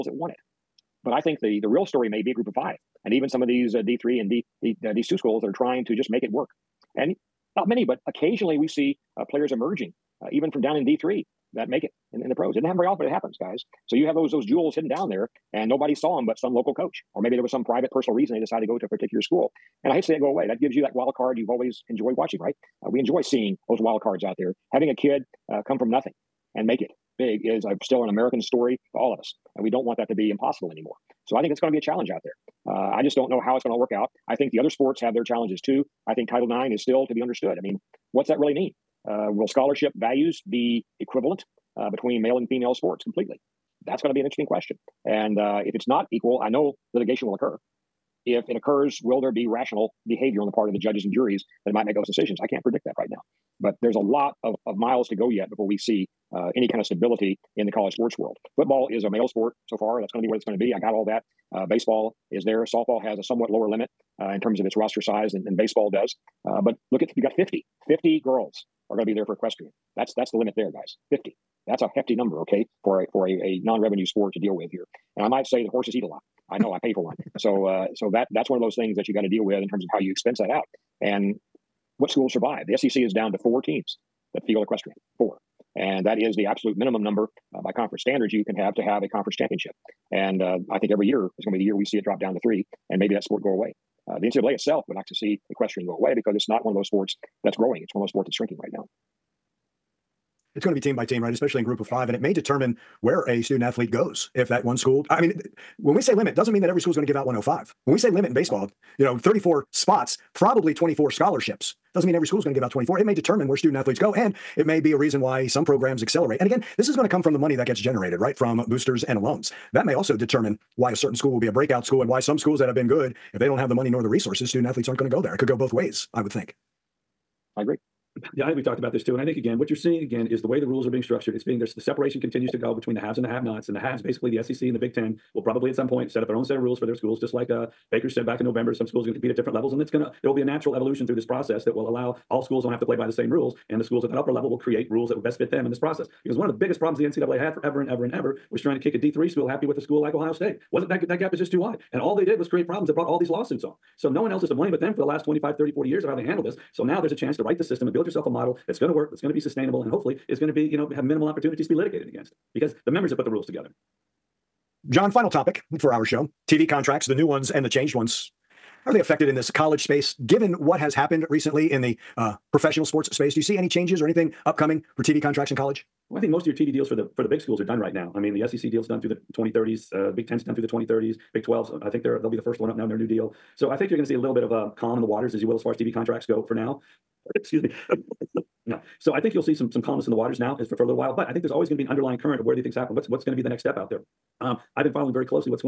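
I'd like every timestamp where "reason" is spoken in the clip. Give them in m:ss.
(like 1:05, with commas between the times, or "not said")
0:18, 1:54.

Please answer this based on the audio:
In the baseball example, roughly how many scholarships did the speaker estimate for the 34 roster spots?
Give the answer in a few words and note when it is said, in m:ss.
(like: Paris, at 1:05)
24, at 1:50.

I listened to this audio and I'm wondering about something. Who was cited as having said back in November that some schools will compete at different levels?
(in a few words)
Baker.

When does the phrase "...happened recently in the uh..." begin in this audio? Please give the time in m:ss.
2:50.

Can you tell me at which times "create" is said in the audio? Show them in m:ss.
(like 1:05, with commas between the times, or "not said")
2:24, 2:32.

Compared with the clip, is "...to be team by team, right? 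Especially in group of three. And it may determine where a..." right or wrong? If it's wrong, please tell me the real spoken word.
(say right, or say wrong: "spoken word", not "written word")
wrong: "five", not "three".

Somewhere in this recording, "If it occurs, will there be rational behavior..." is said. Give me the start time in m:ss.
0:48.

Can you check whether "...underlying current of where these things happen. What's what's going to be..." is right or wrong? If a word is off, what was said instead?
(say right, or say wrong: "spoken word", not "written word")
right.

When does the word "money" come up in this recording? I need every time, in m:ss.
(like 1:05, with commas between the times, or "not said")
1:57, 2:03.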